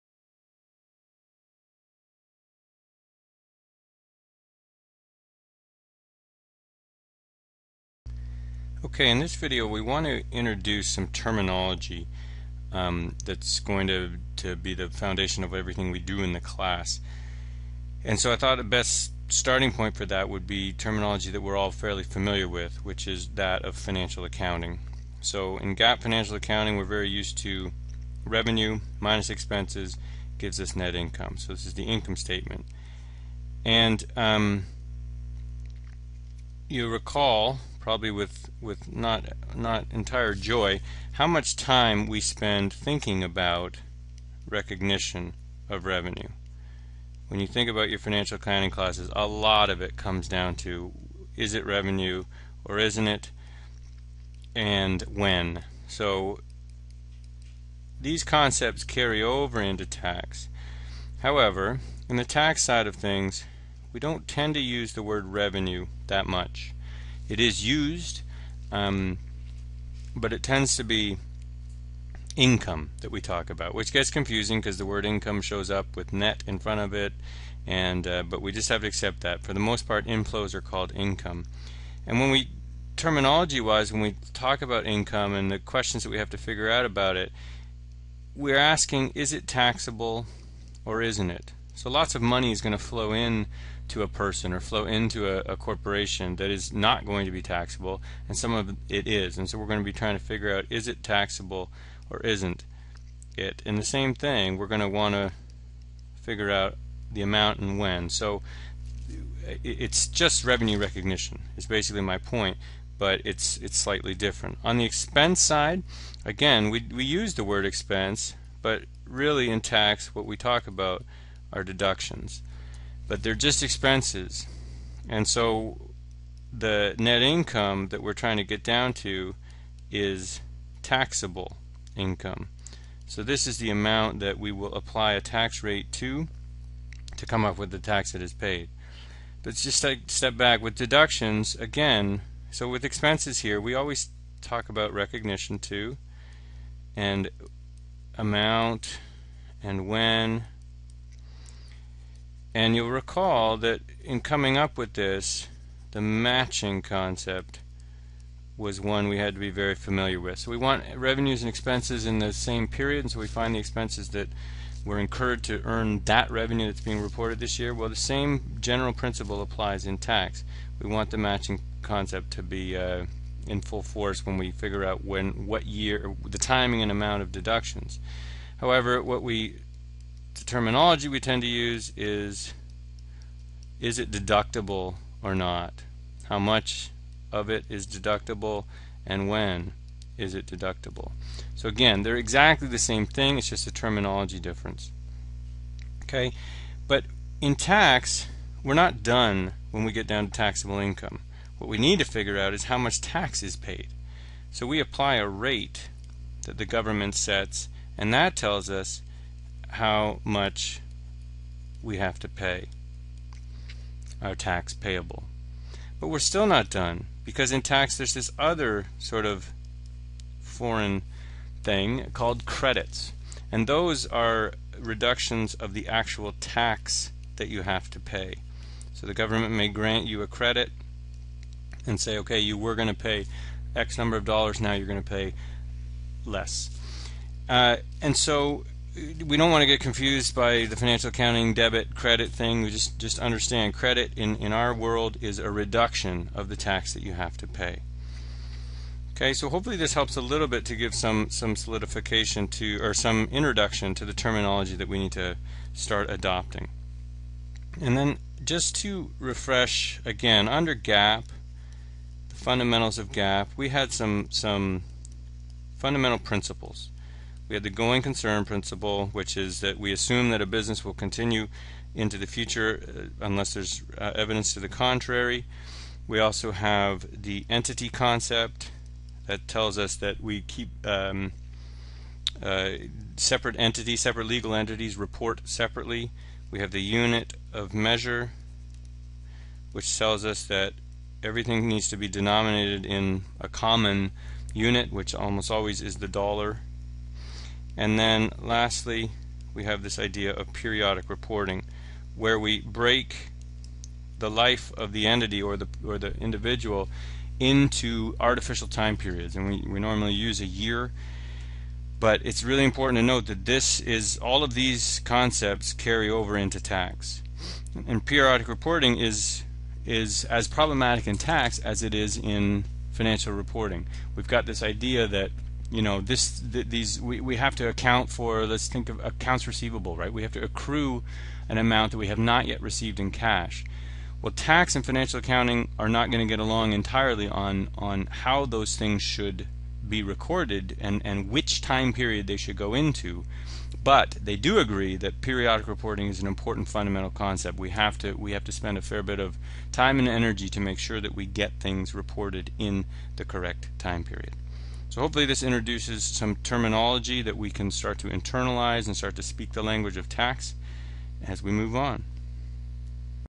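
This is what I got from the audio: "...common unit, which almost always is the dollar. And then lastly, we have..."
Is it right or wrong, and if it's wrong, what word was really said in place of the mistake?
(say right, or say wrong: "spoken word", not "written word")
right.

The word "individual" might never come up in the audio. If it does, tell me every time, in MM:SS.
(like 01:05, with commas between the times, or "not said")
05:06.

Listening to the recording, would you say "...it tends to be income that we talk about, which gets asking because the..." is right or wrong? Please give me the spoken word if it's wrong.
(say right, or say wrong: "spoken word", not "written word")
wrong: "confusing", not "asking".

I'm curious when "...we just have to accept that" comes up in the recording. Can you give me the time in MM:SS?
01:18.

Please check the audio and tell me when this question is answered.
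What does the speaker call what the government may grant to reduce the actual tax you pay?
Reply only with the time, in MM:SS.
03:42.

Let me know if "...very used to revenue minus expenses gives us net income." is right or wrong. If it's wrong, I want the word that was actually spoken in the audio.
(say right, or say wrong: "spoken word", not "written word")
right.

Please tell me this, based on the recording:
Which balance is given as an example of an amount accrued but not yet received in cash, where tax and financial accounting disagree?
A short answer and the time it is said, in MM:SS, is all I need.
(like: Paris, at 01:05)
accounts receivable, at 05:29.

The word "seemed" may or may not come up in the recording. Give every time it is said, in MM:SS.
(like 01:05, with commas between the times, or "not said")
not said.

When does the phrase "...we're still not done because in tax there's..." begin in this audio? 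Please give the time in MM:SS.
03:36.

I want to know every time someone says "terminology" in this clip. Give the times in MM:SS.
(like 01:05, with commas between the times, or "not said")
00:11, 00:20, 01:22, 03:00, 03:13, 04:14, 05:56.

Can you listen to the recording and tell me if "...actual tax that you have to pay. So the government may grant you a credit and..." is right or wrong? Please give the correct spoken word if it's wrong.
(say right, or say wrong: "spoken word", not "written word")
right.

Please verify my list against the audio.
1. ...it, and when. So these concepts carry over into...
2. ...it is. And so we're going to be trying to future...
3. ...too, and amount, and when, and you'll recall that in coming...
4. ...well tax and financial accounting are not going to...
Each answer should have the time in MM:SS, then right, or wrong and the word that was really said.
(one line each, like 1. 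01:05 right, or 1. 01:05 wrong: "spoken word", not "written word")
1. 00:53 right
2. 01:38 wrong: "figure", not "future"
3. 02:25 right
4. 05:34 right.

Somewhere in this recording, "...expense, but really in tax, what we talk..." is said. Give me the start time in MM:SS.
01:57.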